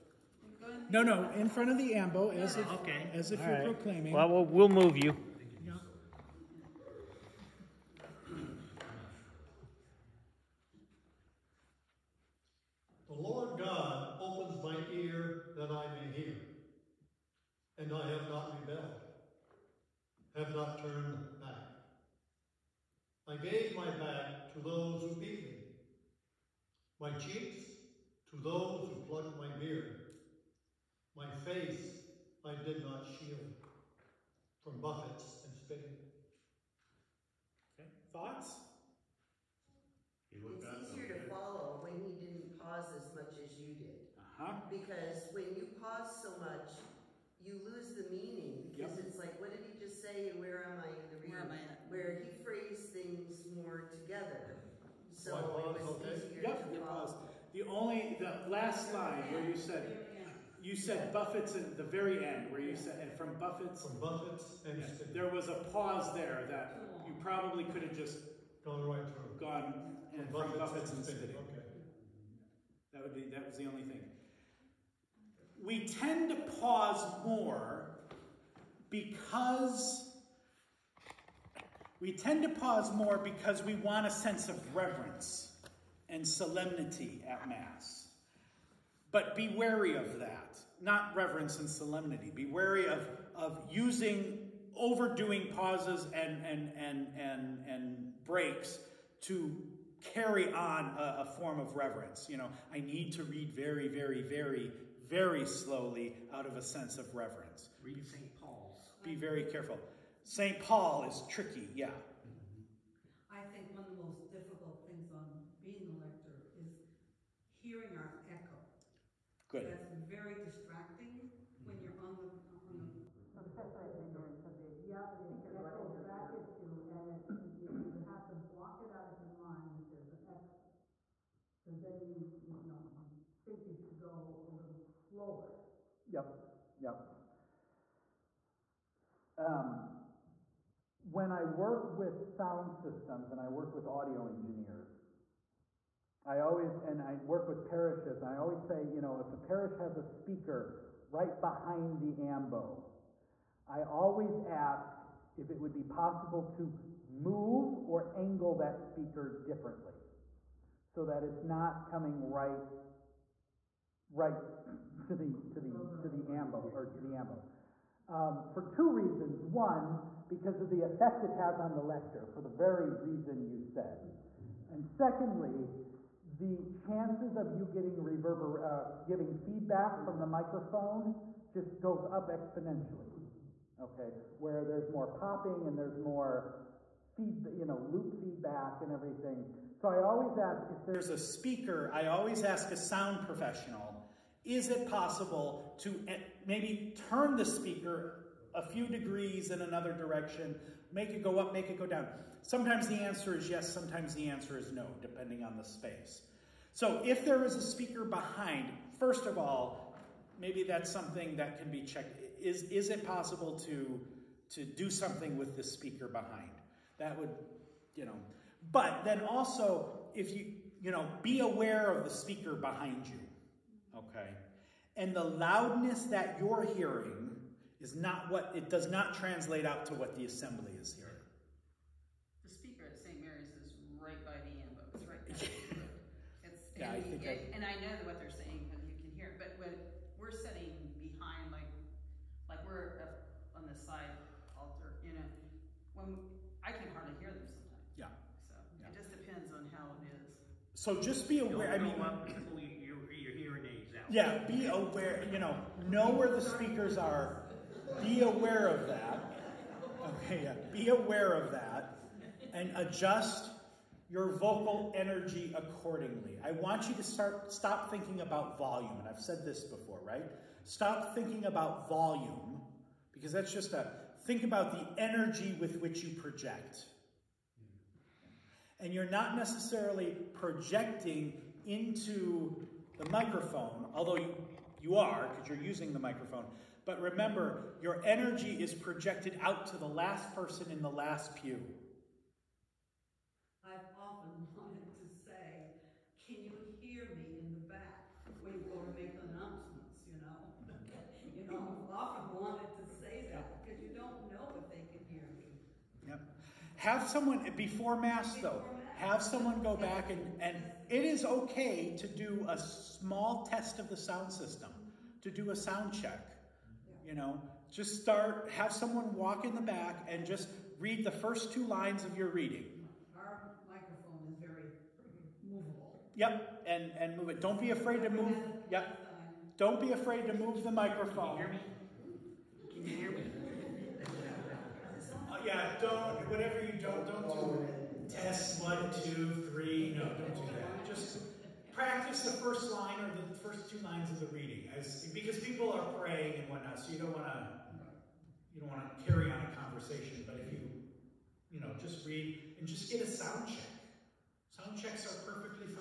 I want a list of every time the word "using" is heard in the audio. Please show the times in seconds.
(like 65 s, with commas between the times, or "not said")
93 s, 285 s.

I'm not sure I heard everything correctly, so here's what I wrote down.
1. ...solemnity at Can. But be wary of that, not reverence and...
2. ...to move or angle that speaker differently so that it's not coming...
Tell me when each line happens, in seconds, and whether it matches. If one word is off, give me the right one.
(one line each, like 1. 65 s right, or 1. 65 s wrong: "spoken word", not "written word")
1. 86 s wrong: "Mass", not "Can"
2. 156 s right.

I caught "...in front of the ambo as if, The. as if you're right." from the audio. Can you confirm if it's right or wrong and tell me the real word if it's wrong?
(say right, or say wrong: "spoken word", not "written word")
wrong: "Okay", not "The".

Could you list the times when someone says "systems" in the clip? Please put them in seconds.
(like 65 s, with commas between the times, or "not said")
142 s, 314 s.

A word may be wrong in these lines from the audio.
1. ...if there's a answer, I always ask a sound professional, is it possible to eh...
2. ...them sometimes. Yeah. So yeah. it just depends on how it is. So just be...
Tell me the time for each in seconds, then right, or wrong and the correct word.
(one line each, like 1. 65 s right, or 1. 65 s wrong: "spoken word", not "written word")
1. 190 s wrong: "speaker", not "answer"
2. 247 s right.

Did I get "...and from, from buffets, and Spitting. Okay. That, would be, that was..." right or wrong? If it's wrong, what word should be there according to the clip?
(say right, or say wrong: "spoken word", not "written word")
right.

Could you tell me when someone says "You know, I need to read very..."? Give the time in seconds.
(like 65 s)
102 s.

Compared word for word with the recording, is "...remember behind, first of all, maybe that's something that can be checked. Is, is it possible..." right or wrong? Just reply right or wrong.
wrong.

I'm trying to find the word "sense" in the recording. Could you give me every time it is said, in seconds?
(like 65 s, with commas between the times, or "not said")
84 s, 106 s.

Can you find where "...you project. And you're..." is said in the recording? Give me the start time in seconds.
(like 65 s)
276 s.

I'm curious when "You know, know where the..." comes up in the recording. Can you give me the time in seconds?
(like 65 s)
255 s.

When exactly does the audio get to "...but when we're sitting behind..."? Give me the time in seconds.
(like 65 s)
239 s.